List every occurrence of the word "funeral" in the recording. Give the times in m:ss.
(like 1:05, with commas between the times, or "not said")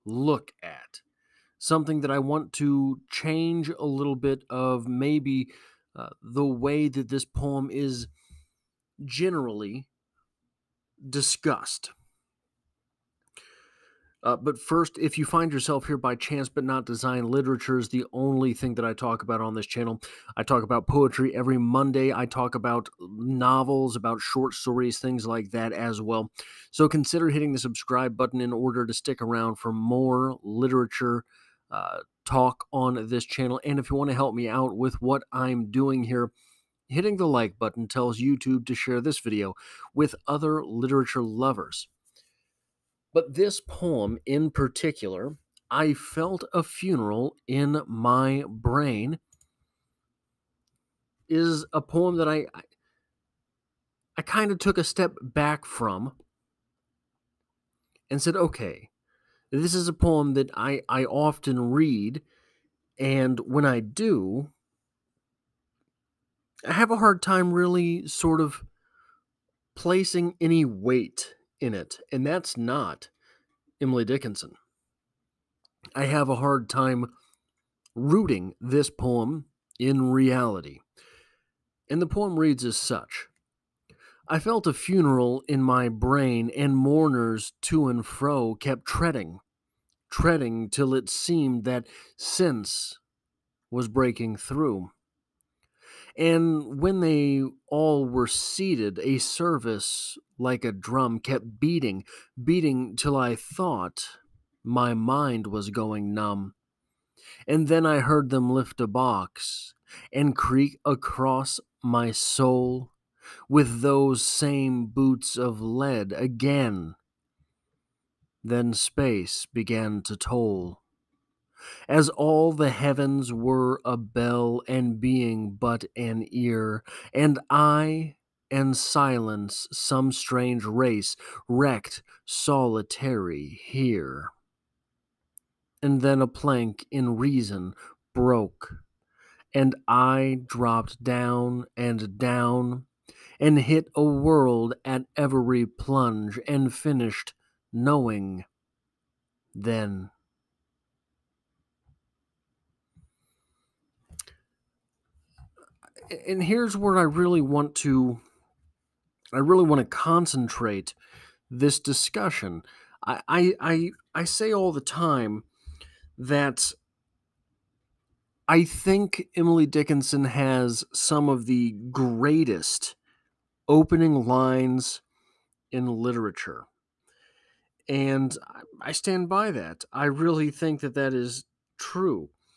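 0:46, 1:24.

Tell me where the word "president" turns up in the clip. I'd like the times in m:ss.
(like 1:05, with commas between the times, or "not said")
not said.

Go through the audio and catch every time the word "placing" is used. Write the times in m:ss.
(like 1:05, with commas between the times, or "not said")
1:09.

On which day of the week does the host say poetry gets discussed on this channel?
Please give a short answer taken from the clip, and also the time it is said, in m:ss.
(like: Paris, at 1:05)
Monday, at 0:21.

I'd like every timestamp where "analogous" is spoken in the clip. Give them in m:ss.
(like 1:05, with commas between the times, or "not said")
not said.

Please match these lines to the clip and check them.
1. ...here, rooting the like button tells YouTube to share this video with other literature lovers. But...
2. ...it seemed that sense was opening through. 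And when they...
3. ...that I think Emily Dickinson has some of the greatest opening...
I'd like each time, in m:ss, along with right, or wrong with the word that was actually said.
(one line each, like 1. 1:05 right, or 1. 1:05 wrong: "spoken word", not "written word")
1. 0:36 wrong: "hitting", not "rooting"
2. 1:30 wrong: "breaking", not "opening"
3. 2:46 right.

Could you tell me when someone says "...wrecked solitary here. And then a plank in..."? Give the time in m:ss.
2:11.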